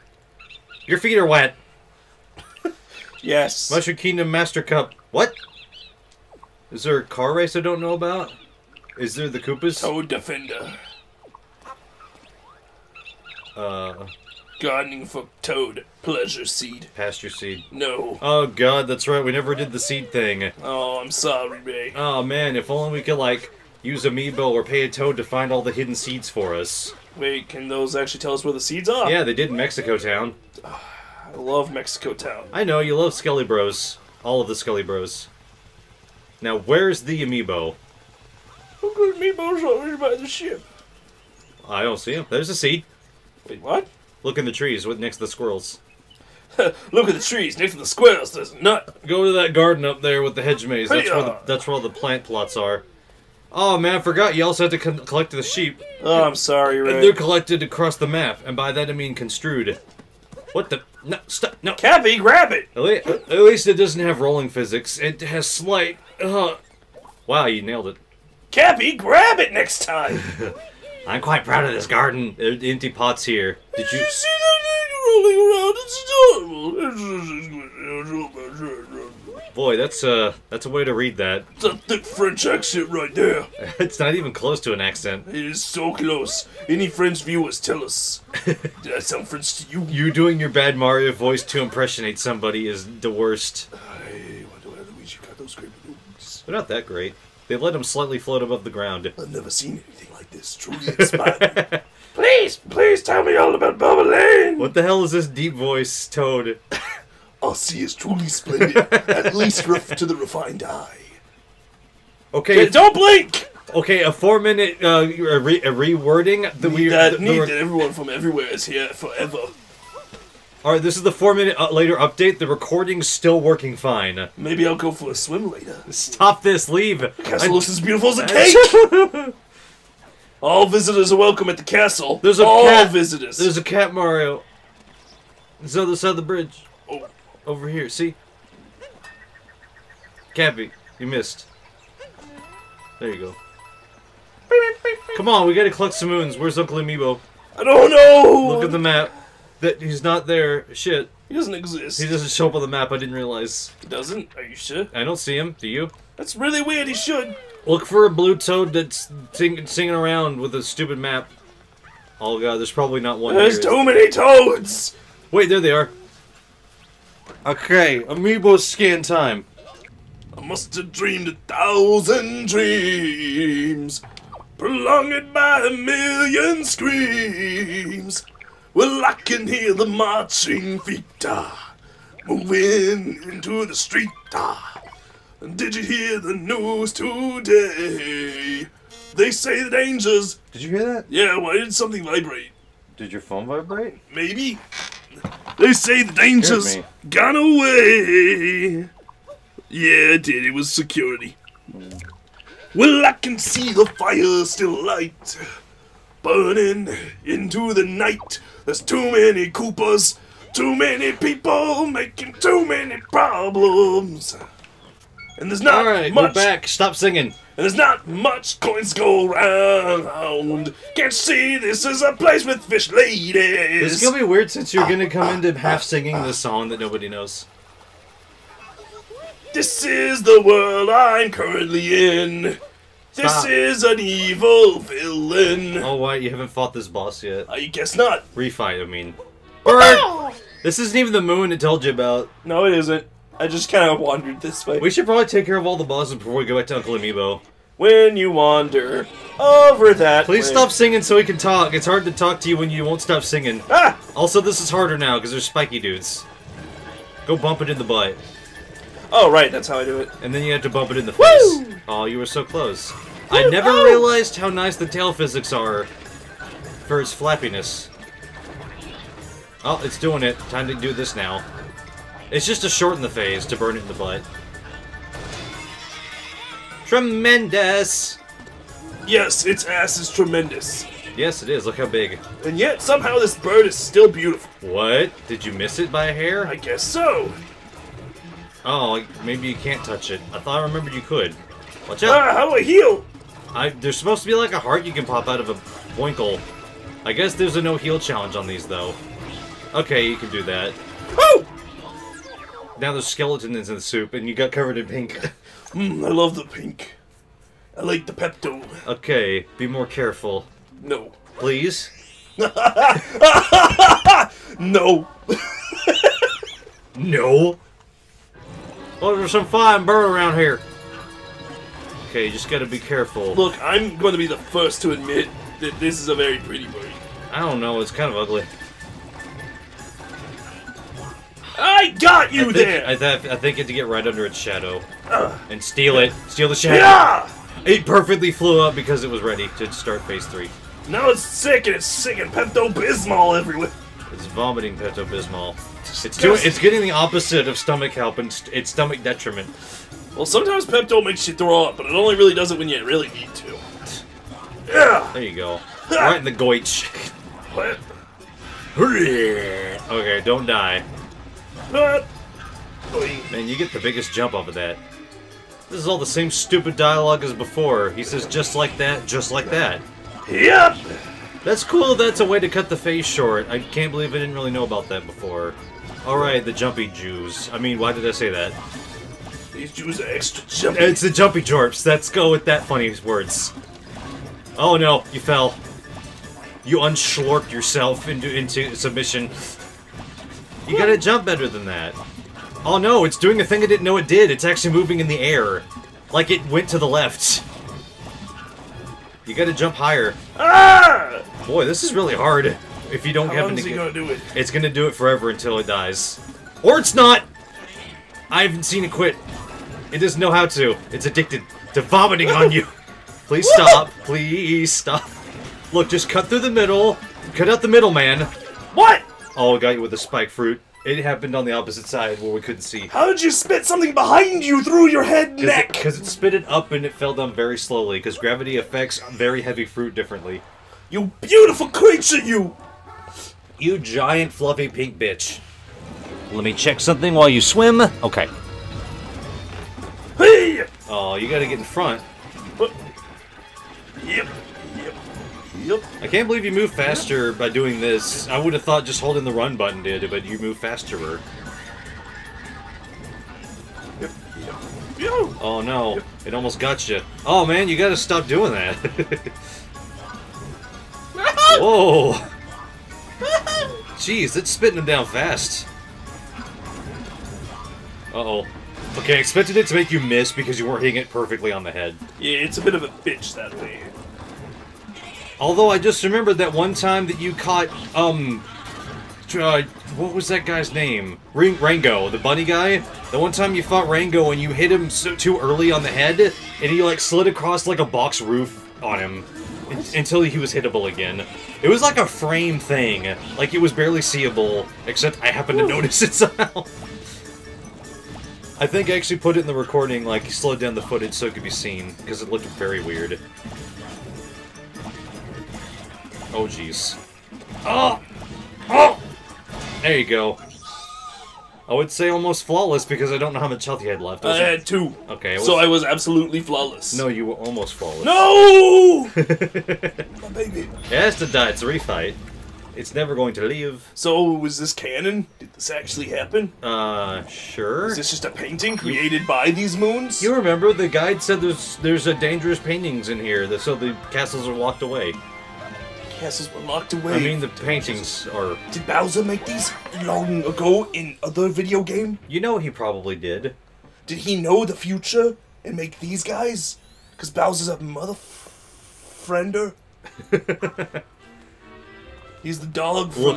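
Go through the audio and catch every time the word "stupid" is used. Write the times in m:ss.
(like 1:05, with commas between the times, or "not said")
2:40, 6:06.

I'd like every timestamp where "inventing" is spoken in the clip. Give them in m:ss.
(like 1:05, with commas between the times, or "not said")
not said.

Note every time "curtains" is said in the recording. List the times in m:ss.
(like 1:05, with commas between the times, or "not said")
not said.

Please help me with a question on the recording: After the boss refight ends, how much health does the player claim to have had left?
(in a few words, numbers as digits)
2.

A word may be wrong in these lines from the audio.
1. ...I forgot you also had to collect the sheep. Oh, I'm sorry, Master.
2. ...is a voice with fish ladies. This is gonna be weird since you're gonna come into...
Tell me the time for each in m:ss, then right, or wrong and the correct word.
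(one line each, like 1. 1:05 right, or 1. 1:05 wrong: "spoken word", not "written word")
1. 0:53 wrong: "Ray", not "Master"
2. 3:41 wrong: "place", not "voice".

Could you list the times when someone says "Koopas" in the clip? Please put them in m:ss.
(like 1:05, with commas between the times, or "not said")
0:09, 3:29.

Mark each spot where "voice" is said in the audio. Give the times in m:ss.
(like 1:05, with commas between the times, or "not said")
1:31, 1:45.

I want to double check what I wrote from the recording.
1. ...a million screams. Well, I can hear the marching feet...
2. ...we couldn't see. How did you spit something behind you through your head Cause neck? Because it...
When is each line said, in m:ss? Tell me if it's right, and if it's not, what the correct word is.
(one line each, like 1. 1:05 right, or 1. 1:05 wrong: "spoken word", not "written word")
1. 2:55 right
2. 7:02 right.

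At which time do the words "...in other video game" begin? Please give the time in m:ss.
9:00.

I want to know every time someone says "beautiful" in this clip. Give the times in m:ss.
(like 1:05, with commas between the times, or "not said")
2:07, 4:44, 7:11.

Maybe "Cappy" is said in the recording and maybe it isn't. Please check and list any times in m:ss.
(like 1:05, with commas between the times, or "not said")
1:01, 1:08, 2:20.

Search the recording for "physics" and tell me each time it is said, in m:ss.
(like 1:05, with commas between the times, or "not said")
1:04, 4:25.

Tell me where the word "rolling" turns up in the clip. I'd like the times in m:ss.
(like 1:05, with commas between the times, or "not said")
1:04, 1:16.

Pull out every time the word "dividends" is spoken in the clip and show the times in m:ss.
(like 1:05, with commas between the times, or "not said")
not said.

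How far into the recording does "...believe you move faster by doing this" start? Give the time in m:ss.
7:26.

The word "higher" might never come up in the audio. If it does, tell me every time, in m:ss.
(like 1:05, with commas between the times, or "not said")
6:39.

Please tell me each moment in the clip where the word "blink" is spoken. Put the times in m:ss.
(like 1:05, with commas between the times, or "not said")
1:52.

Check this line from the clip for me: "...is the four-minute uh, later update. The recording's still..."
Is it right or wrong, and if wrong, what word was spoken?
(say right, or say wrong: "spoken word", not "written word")
right.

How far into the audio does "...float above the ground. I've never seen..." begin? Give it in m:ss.
1:38.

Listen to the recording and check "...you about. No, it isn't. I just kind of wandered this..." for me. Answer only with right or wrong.
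right.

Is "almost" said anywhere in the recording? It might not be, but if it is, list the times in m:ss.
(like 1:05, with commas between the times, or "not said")
7:36, 8:32, 8:37.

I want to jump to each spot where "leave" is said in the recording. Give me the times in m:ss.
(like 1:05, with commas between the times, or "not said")
2:06, 8:43.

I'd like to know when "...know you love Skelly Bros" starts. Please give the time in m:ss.
0:32.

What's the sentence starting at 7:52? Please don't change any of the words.
Yeah, it's a bit of a bitch that way.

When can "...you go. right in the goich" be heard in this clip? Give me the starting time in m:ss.
5:55.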